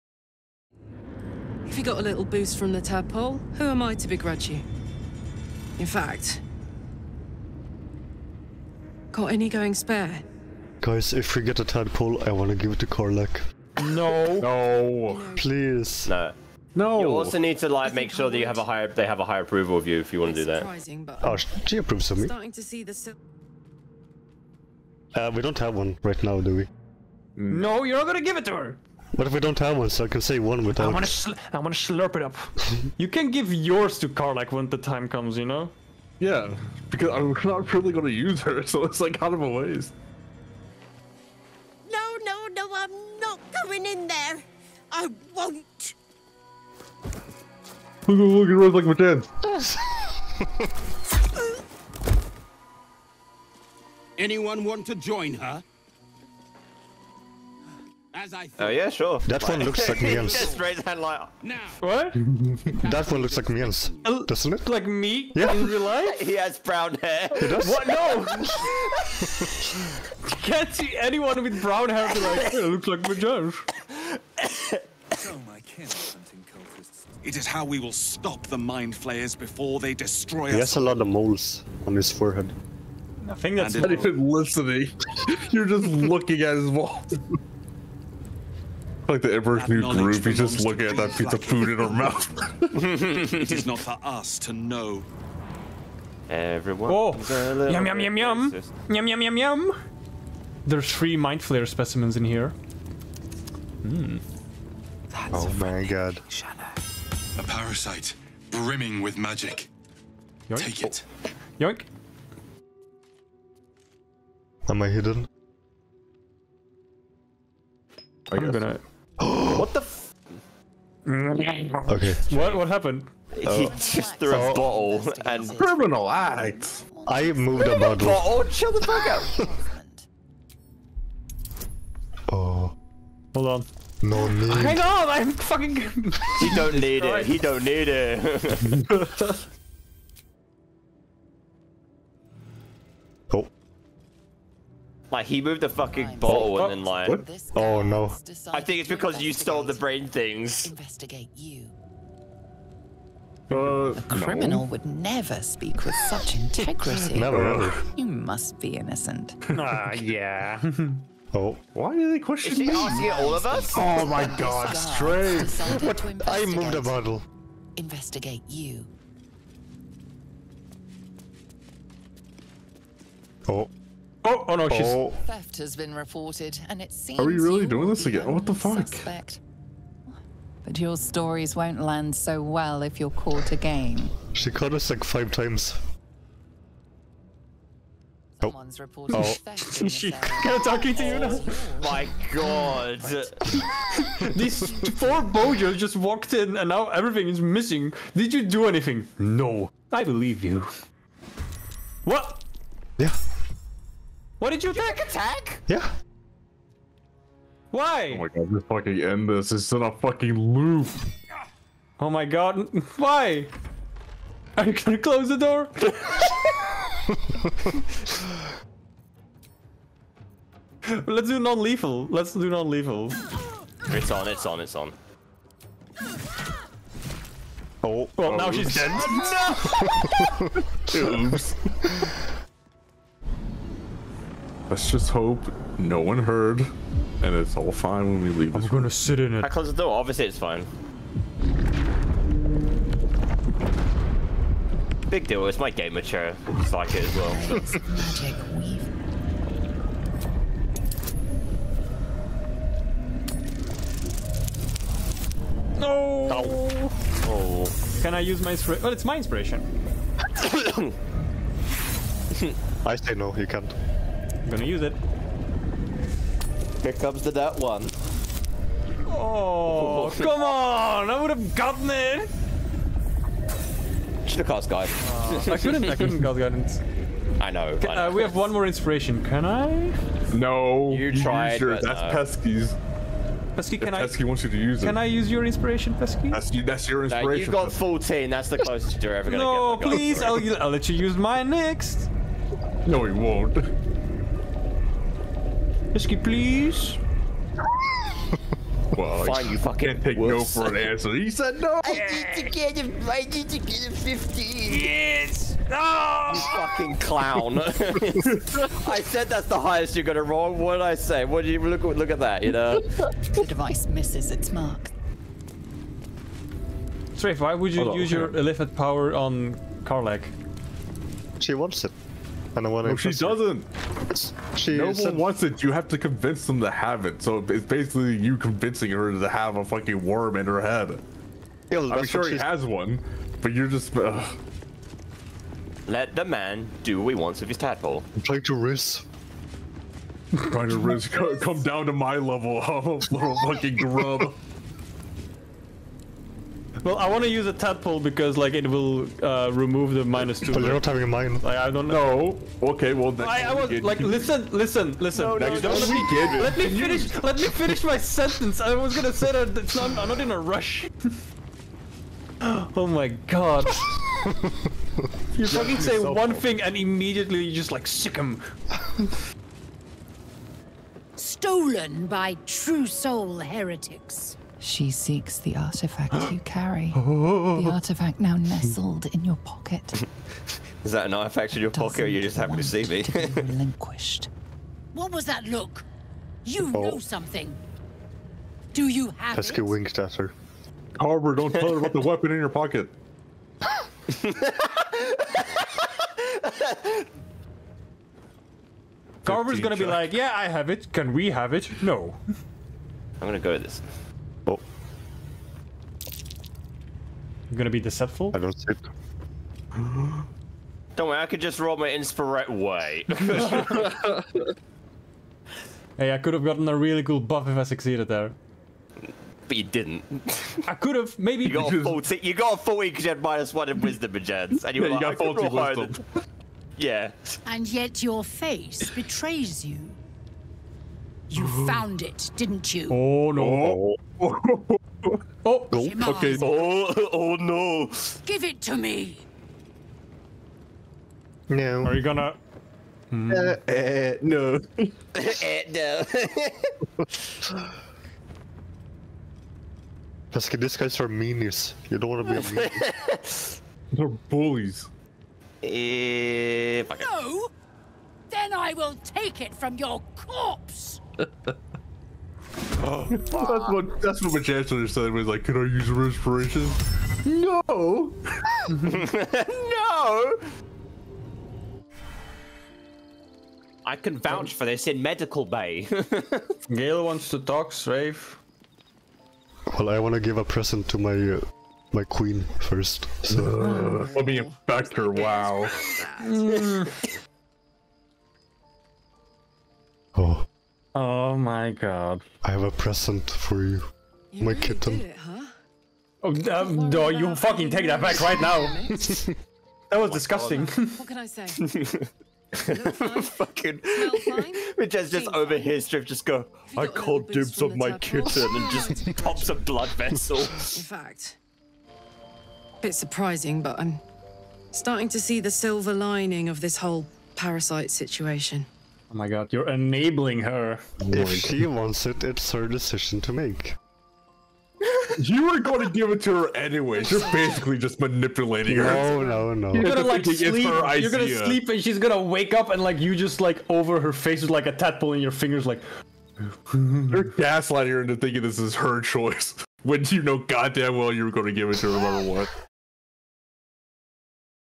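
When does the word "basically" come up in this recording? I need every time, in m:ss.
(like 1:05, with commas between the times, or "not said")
5:27, 8:47.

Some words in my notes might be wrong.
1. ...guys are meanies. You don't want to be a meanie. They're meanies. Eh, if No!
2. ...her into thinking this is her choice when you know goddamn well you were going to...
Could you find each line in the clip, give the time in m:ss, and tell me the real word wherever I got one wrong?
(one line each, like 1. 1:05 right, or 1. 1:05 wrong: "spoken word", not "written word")
1. 7:30 wrong: "bullies", not "meanies"
2. 8:57 right.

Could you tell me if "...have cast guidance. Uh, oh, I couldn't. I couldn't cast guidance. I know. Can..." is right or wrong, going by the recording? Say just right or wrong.
right.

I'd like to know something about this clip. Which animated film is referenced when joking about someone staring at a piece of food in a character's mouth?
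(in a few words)
The Emperor's New Groove.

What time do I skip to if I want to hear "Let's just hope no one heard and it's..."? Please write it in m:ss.
3:54.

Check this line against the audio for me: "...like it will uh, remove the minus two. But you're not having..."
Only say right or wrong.
right.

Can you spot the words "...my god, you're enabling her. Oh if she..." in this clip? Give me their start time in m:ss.
8:39.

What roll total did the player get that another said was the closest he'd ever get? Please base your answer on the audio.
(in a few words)
14.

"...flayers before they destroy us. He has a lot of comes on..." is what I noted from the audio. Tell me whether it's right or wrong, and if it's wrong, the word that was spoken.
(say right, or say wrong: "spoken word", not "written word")
wrong: "moles", not "comes".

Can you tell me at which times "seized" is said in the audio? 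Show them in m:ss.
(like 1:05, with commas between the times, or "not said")
not said.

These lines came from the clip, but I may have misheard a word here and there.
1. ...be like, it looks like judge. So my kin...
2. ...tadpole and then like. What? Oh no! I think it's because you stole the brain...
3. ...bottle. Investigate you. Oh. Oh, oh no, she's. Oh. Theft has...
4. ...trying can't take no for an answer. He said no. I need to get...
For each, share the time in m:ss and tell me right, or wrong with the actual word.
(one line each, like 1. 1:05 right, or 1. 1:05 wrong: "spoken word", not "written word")
1. 1:12 right
2. 2:26 wrong: "bottle", not "tadpole"
3. 2:46 right
4. 4:59 wrong: "fucking", not "trying".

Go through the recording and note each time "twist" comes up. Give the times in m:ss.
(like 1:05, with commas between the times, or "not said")
not said.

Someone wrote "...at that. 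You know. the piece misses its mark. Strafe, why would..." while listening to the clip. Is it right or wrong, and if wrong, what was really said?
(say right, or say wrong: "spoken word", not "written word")
wrong: "device", not "piece".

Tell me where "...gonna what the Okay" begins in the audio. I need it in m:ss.
1:58.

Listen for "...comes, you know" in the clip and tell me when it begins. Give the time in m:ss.
0:35.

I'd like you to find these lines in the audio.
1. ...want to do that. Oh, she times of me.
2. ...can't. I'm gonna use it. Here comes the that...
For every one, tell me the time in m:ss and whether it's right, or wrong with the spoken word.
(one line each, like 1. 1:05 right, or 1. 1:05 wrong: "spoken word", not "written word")
1. 0:20 wrong: "approves", not "times"
2. 4:23 right.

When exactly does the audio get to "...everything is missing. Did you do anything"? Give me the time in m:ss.
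3:16.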